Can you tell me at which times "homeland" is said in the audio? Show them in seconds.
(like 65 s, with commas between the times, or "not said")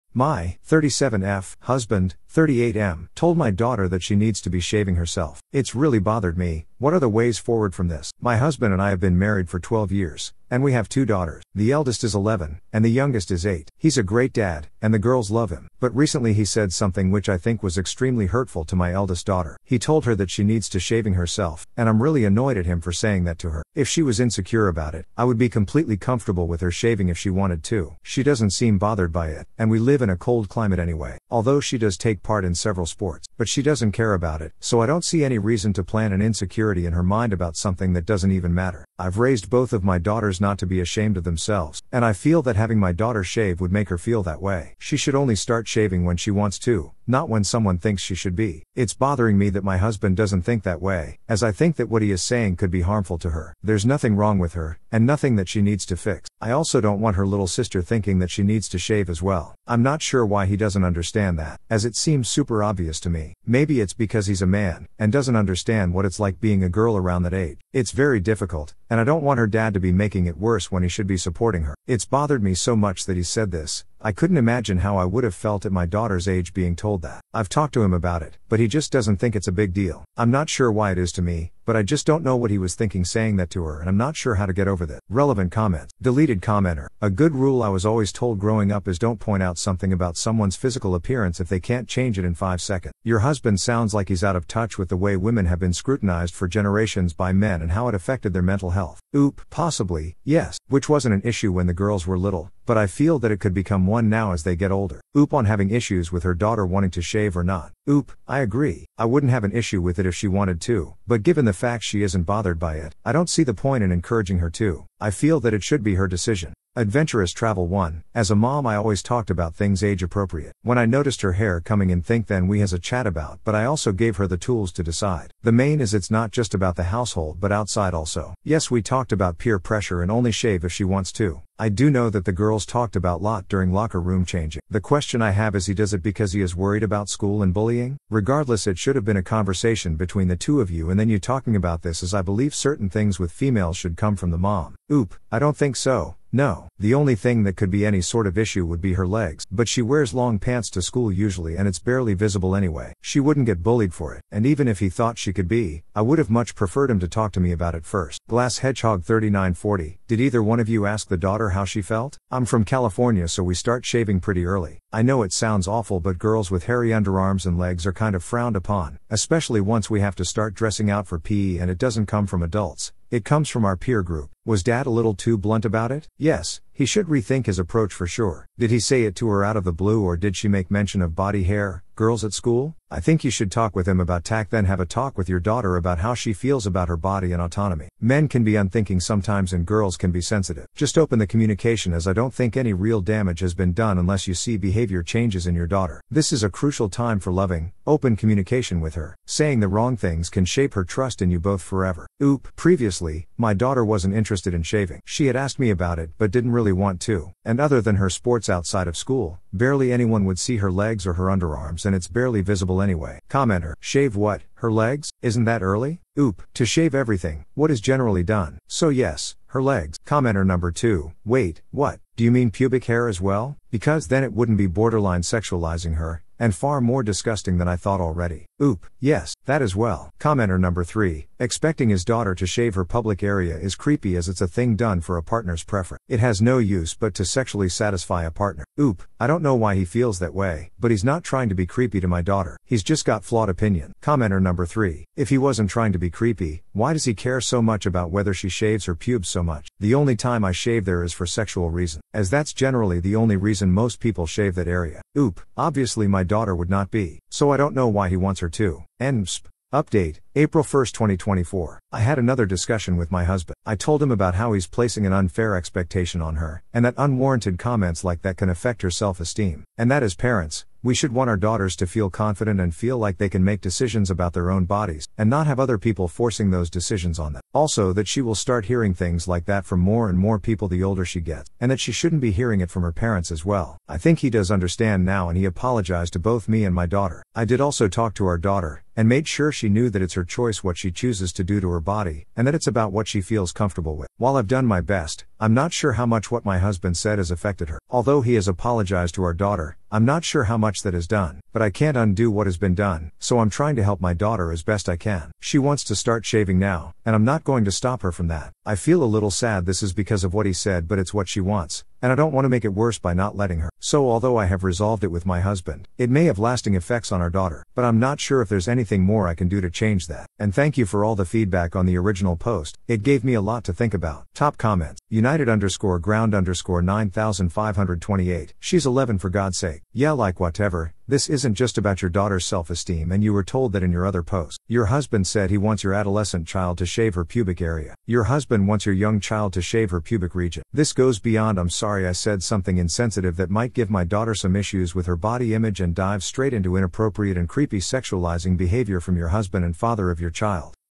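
not said.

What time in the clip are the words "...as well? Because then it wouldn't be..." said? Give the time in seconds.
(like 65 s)
223 s.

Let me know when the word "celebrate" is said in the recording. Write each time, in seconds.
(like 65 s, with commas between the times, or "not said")
not said.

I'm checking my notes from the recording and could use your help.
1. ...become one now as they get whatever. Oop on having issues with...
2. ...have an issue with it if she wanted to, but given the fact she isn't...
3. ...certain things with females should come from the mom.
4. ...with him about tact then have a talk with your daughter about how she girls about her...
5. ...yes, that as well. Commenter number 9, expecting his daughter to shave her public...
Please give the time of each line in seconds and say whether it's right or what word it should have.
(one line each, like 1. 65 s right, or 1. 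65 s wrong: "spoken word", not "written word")
1. 103 s wrong: "older", not "whatever"
2. 109 s right
3. 142 s right
4. 183 s wrong: "feels", not "girls"
5. 228 s wrong: "3", not "9".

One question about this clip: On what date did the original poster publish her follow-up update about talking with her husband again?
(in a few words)
April 1, 2024.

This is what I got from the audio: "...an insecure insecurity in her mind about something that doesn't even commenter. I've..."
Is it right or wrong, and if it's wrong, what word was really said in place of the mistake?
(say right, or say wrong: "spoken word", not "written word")
wrong: "matter", not "commenter".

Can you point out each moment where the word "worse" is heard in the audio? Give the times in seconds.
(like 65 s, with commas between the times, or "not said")
70 s, 312 s.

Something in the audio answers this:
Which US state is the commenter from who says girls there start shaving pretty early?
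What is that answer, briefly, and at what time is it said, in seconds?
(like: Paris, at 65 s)
California, at 162 s.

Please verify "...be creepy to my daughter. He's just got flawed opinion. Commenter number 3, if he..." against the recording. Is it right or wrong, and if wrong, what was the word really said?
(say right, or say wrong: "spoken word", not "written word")
right.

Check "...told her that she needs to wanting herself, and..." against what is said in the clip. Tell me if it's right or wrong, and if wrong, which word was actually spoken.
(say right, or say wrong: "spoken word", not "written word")
wrong: "shaving", not "wanting".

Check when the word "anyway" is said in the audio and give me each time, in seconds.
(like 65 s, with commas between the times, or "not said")
30 s, 152 s, 212 s.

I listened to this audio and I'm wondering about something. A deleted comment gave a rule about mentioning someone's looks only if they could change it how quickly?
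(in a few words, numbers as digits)
5 seconds.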